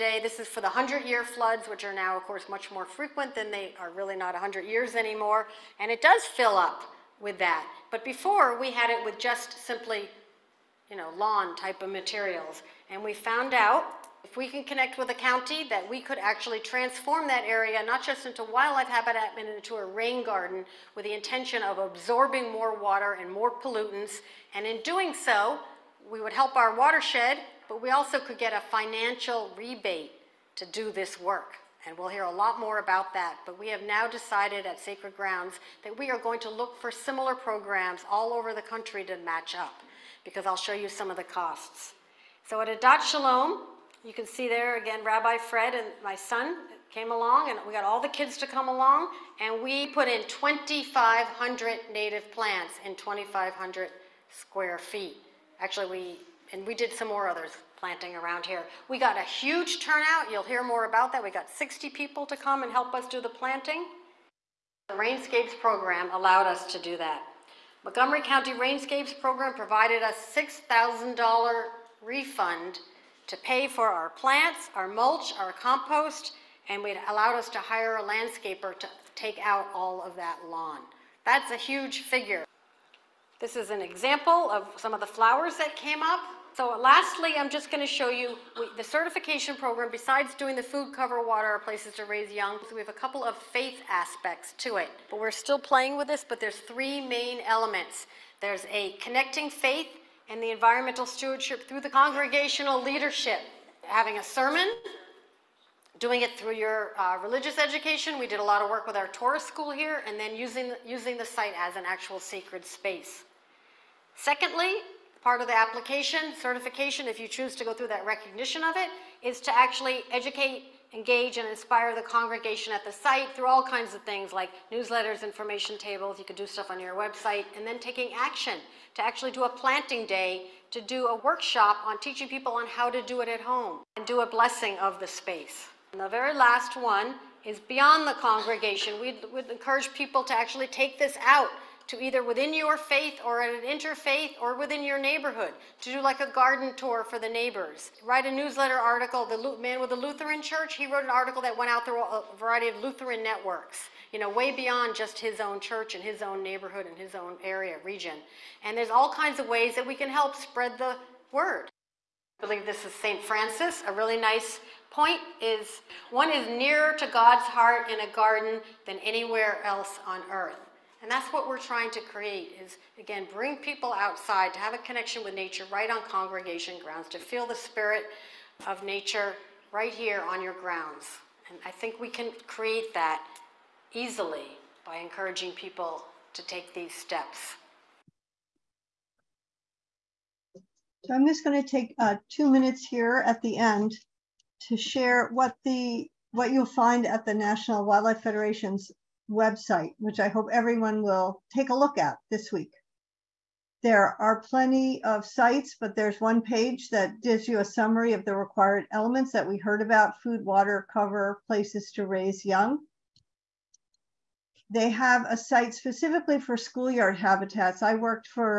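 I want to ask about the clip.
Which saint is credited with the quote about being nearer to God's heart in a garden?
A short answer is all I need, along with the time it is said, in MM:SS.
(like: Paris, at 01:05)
St. Francis, at 02:42.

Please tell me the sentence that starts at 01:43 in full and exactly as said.
Having a sermon, doing it through your uh, religious education.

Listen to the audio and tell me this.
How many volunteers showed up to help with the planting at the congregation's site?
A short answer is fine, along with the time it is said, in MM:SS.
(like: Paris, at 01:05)
60, at 01:01.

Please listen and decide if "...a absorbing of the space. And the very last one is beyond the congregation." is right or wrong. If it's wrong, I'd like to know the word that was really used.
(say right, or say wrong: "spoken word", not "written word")
wrong: "blessing", not "absorbing".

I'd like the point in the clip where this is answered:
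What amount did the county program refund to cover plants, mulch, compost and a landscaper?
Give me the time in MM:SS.
01:10.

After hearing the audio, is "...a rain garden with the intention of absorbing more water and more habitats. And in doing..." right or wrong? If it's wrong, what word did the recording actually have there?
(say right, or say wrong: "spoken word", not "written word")
wrong: "pollutants", not "habitats".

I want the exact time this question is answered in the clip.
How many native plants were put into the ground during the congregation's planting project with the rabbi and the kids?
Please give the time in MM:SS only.
00:50.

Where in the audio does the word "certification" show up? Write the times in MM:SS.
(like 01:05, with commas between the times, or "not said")
01:28, 01:56.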